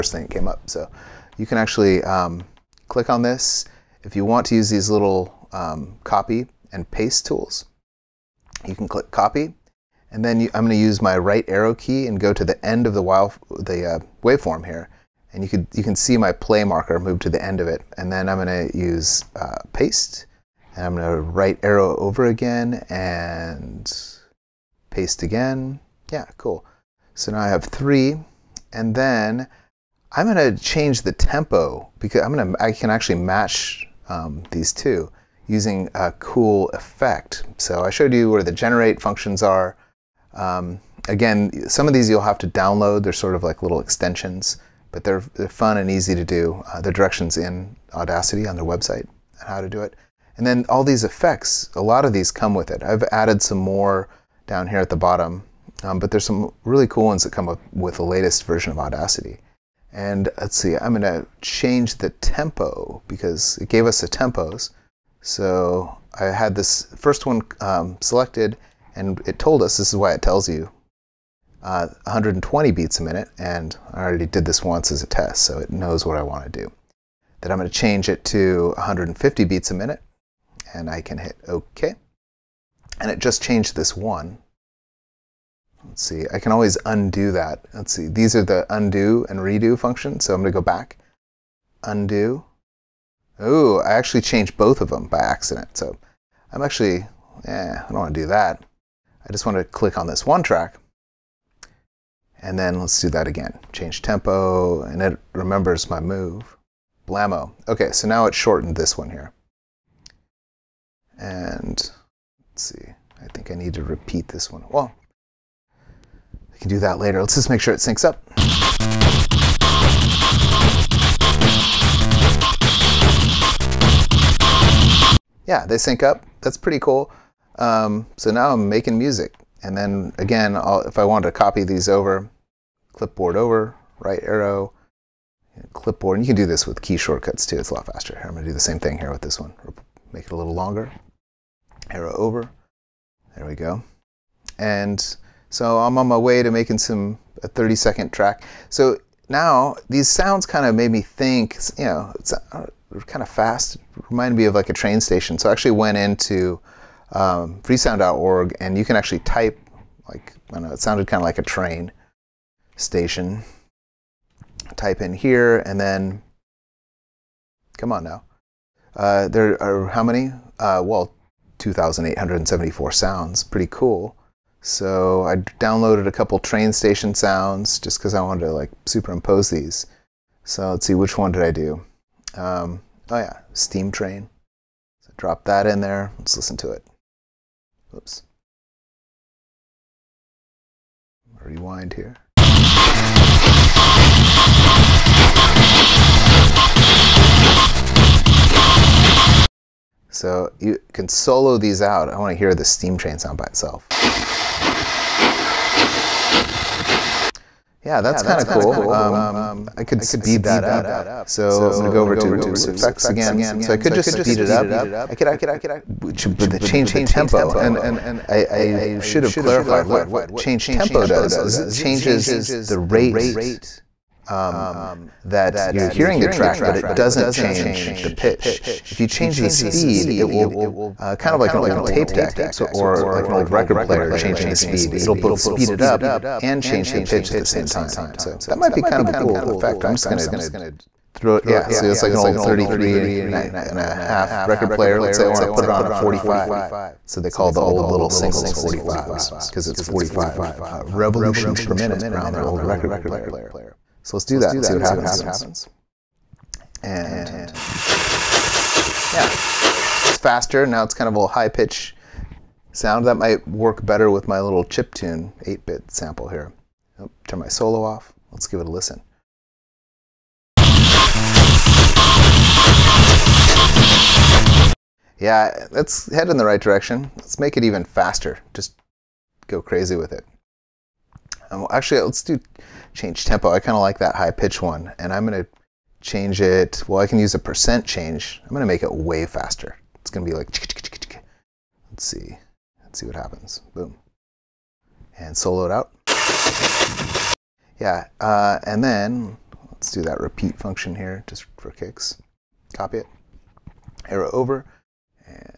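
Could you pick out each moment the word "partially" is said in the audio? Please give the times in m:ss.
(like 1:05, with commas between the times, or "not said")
not said.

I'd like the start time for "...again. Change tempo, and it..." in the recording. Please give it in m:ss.
1:43.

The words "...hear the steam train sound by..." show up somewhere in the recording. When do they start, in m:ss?
3:22.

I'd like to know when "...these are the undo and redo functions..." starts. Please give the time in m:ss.
1:28.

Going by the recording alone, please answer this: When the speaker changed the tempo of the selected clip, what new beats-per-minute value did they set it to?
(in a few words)
150.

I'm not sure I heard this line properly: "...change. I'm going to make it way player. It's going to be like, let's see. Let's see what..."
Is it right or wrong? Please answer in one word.
wrong.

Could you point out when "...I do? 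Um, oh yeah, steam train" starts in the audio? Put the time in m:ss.
3:01.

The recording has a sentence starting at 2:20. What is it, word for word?
Make it a little longer arrow over.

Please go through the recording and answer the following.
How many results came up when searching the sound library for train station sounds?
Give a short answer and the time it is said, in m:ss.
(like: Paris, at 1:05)
2,874, at 2:51.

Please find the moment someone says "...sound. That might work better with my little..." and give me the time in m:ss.
4:22.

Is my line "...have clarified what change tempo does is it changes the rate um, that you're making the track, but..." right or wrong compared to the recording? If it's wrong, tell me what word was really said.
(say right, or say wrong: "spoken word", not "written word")
wrong: "hearing", not "making".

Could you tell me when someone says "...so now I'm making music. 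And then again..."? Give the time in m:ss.
2:08.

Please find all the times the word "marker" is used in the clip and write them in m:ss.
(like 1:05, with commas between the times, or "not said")
0:16.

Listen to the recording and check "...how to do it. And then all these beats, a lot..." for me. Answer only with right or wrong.
wrong.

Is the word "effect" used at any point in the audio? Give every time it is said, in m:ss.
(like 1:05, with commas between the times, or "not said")
0:36, 0:51, 3:32, 3:59.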